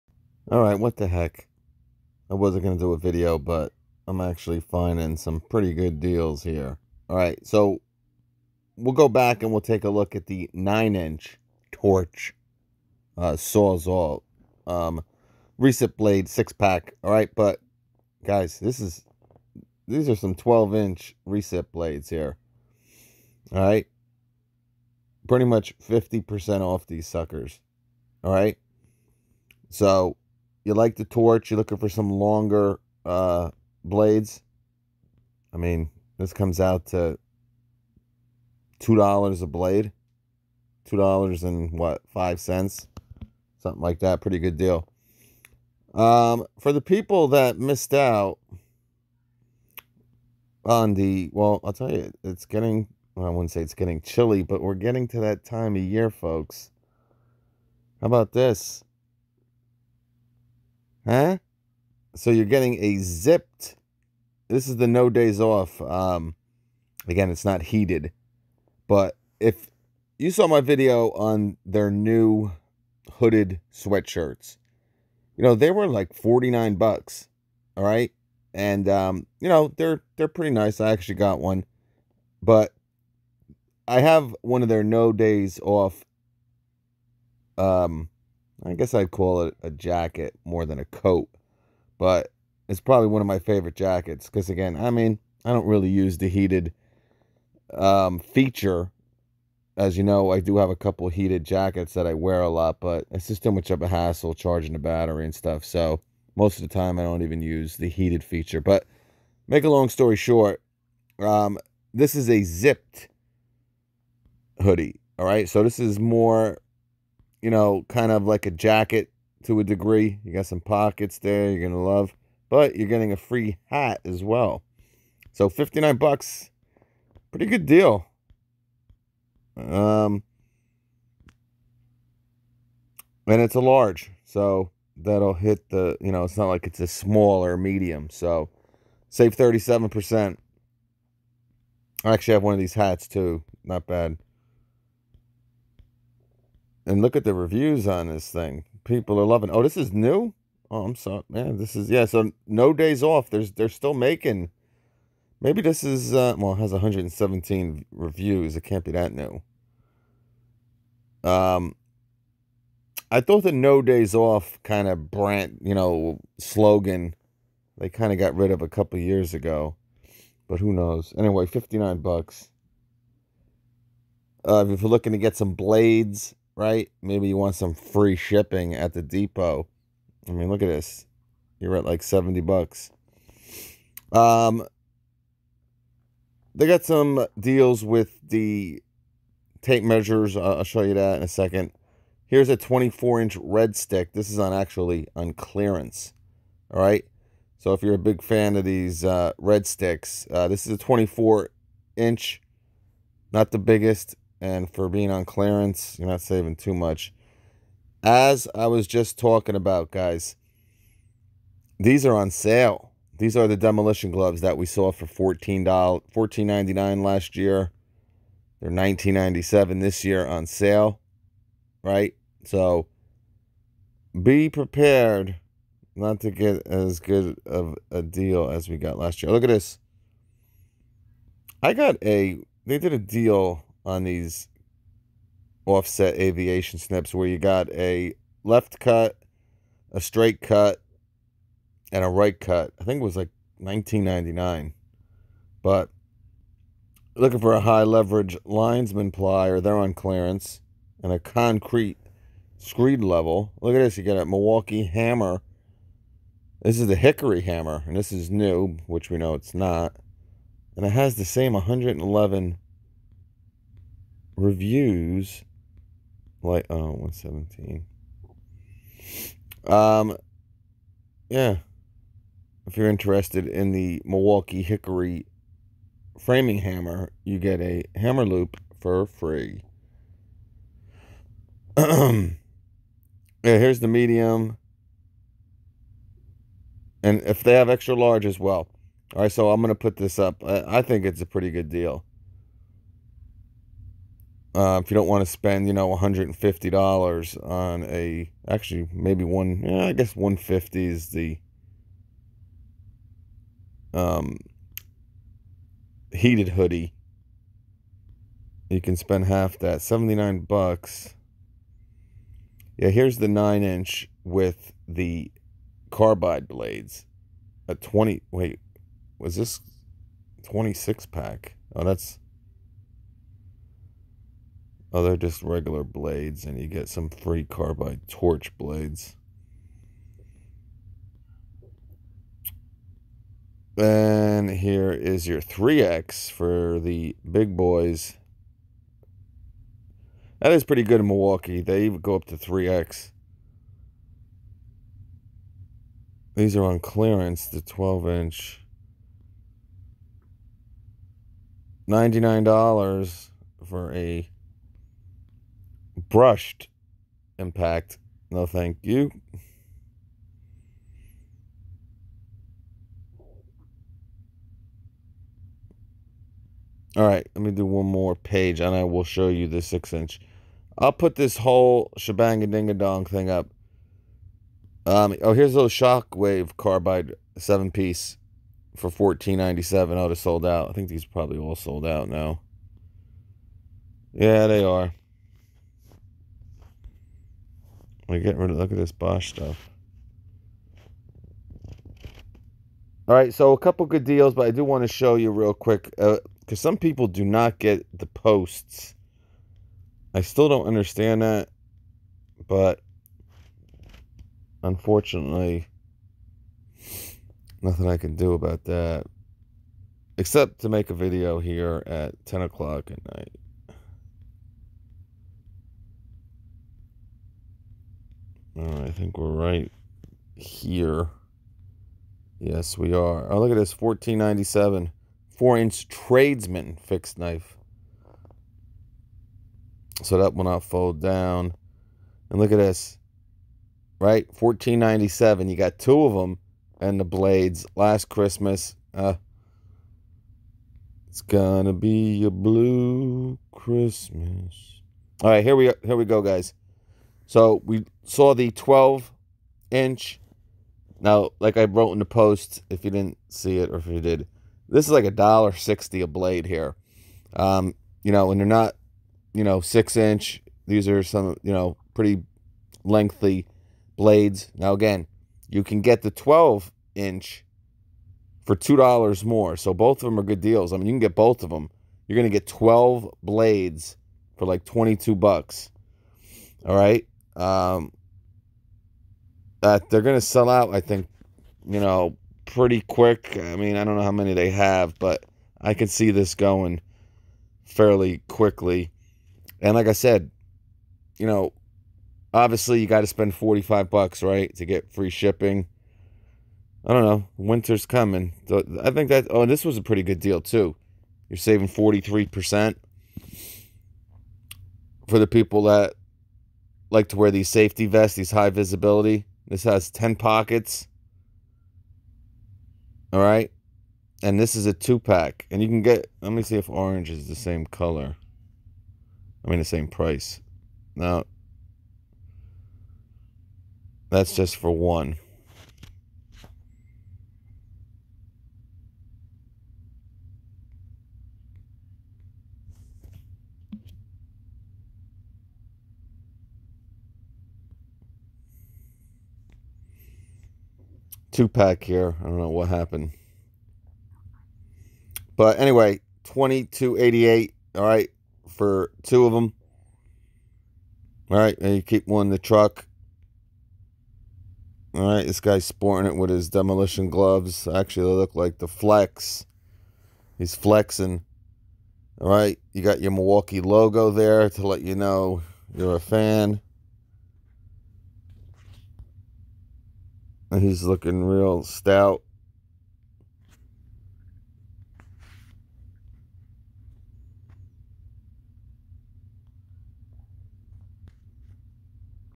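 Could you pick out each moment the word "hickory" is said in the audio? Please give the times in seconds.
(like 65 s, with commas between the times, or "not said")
256 s, 274 s.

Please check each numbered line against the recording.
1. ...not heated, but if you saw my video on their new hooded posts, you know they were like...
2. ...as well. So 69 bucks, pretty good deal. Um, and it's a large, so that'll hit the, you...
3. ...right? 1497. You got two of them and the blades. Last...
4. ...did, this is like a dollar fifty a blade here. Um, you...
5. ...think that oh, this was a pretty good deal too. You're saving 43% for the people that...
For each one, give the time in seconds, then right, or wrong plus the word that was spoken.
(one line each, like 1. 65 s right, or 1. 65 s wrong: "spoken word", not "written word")
1. 67 s wrong: "sweatshirts", not "posts"
2. 124 s wrong: "59", not "69"
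3. 433 s right
4. 454 s wrong: "sixty", not "fifty"
5. 498 s right.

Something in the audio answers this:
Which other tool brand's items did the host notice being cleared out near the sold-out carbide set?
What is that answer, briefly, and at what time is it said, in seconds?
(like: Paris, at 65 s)
Bosch, at 388 s.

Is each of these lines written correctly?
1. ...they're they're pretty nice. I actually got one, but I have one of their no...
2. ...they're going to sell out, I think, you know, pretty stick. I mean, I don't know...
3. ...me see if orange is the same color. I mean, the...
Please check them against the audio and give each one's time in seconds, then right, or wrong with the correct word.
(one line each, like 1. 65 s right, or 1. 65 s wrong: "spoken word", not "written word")
1. 79 s right
2. 479 s wrong: "quick", not "stick"
3. 516 s right.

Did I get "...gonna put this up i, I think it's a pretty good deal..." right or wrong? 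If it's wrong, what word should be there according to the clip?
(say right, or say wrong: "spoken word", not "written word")
right.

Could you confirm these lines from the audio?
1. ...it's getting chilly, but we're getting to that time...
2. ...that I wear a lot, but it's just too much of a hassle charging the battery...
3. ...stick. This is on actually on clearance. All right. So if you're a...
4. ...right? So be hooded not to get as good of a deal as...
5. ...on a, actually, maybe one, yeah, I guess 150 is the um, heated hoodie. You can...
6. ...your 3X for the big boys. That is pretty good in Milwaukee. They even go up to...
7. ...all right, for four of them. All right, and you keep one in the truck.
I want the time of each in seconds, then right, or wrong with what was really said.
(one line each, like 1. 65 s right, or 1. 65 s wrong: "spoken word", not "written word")
1. 53 s right
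2. 101 s right
3. 193 s right
4. 221 s wrong: "prepared", not "hooded"
5. 297 s right
6. 335 s right
7. 547 s wrong: "two", not "four".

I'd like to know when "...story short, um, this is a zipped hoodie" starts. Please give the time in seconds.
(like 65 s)
109 s.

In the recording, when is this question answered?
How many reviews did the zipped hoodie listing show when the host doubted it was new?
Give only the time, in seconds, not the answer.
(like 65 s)
156 s.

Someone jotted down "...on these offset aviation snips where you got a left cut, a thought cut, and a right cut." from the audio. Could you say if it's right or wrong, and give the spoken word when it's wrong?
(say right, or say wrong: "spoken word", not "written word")
wrong: "straight", not "thought".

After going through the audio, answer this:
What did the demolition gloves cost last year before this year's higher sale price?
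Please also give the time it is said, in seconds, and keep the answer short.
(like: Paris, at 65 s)
$14.99, at 215 s.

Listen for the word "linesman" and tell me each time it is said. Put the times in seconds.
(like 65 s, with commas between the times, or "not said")
248 s.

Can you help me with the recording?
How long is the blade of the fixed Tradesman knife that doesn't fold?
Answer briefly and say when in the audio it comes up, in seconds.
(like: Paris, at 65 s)
4 inch, at 425 s.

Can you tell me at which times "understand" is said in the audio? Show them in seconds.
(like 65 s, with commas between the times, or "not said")
400 s.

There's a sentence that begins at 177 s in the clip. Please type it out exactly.
Maybe you want some free shipping at the depot.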